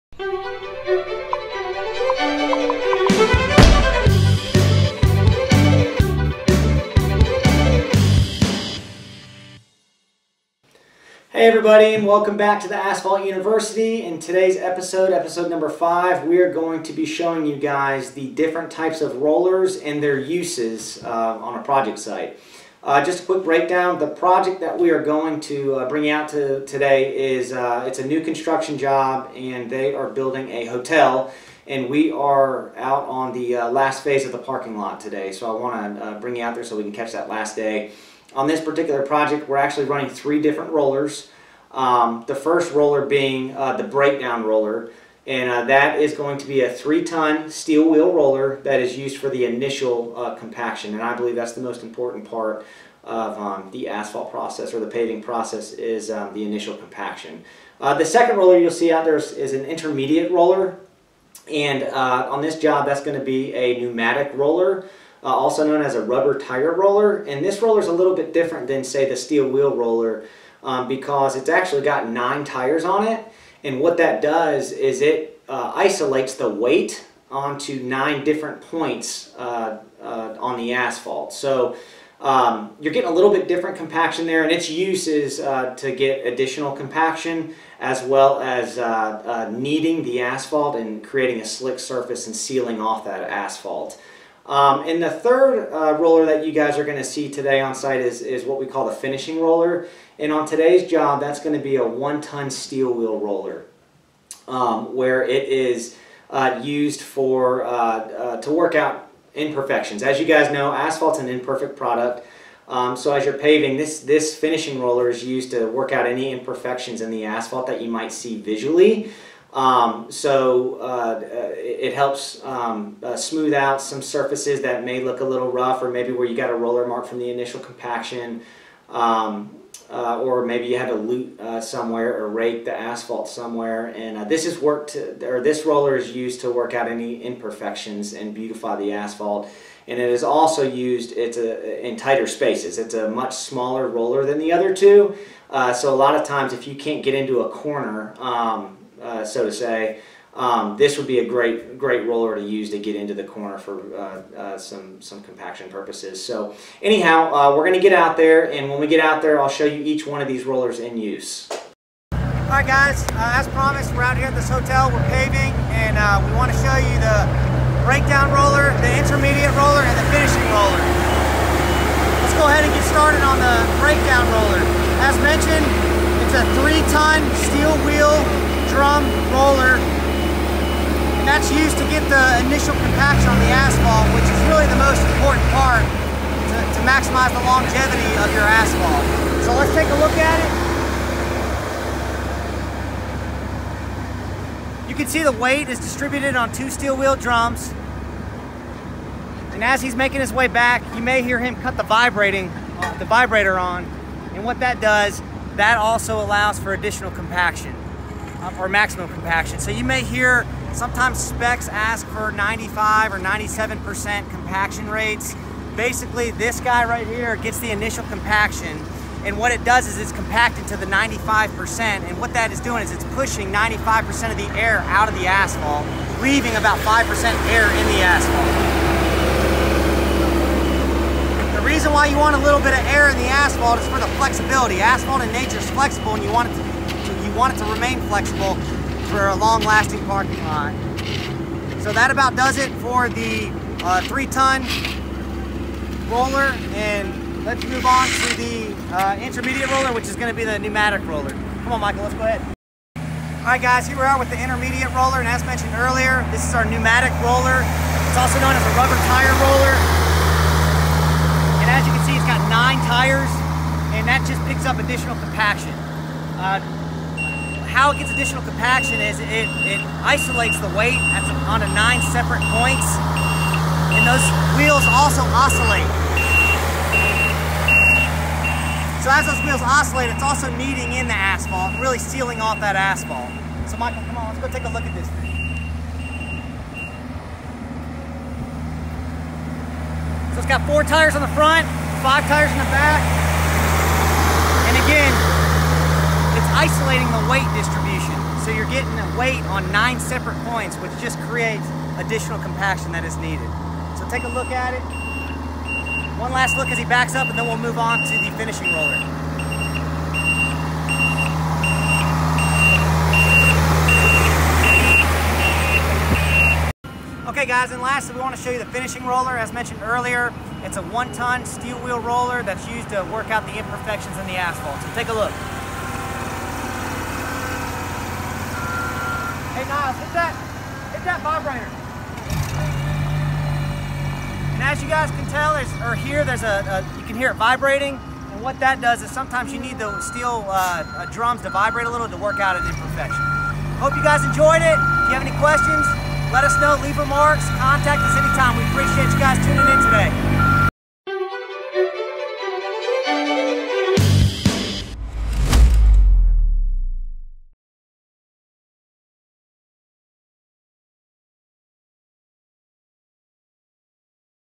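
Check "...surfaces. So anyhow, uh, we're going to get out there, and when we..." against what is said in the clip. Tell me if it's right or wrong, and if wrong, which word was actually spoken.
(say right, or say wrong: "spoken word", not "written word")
wrong: "purposes", not "surfaces".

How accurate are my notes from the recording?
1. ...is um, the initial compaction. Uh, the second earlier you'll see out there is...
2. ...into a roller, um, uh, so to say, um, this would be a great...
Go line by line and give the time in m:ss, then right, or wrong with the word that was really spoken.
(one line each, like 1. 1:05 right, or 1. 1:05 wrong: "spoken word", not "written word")
1. 0:55 wrong: "roller", not "earlier"
2. 2:27 wrong: "corner", not "roller".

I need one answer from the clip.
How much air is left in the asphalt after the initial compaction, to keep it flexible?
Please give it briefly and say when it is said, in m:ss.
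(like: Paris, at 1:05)
5%, at 3:46.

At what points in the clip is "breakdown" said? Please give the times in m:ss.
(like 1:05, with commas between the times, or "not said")
0:23, 0:43, 2:47, 2:53.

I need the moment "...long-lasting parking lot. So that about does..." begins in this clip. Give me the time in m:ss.
3:59.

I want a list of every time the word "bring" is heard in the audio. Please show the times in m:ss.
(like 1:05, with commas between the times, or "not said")
0:25, 0:36.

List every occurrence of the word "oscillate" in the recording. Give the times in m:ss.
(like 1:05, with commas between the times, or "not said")
4:35, 4:39.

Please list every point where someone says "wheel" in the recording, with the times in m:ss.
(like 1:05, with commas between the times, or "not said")
0:47, 1:09, 1:42, 2:57, 3:16, 4:34, 4:39, 5:21.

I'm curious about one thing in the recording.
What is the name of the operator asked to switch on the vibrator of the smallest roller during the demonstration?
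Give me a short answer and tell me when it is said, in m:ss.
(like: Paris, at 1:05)
Niles, at 5:29.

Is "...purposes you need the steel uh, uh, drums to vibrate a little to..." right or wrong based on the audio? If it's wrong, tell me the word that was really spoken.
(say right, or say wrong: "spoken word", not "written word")
wrong: "sometimes", not "purposes".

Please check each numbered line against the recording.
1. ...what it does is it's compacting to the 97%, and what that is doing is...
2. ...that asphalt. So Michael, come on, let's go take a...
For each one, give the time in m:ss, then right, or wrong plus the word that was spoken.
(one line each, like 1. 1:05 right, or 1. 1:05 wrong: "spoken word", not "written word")
1. 3:39 wrong: "95", not "97"
2. 4:42 right.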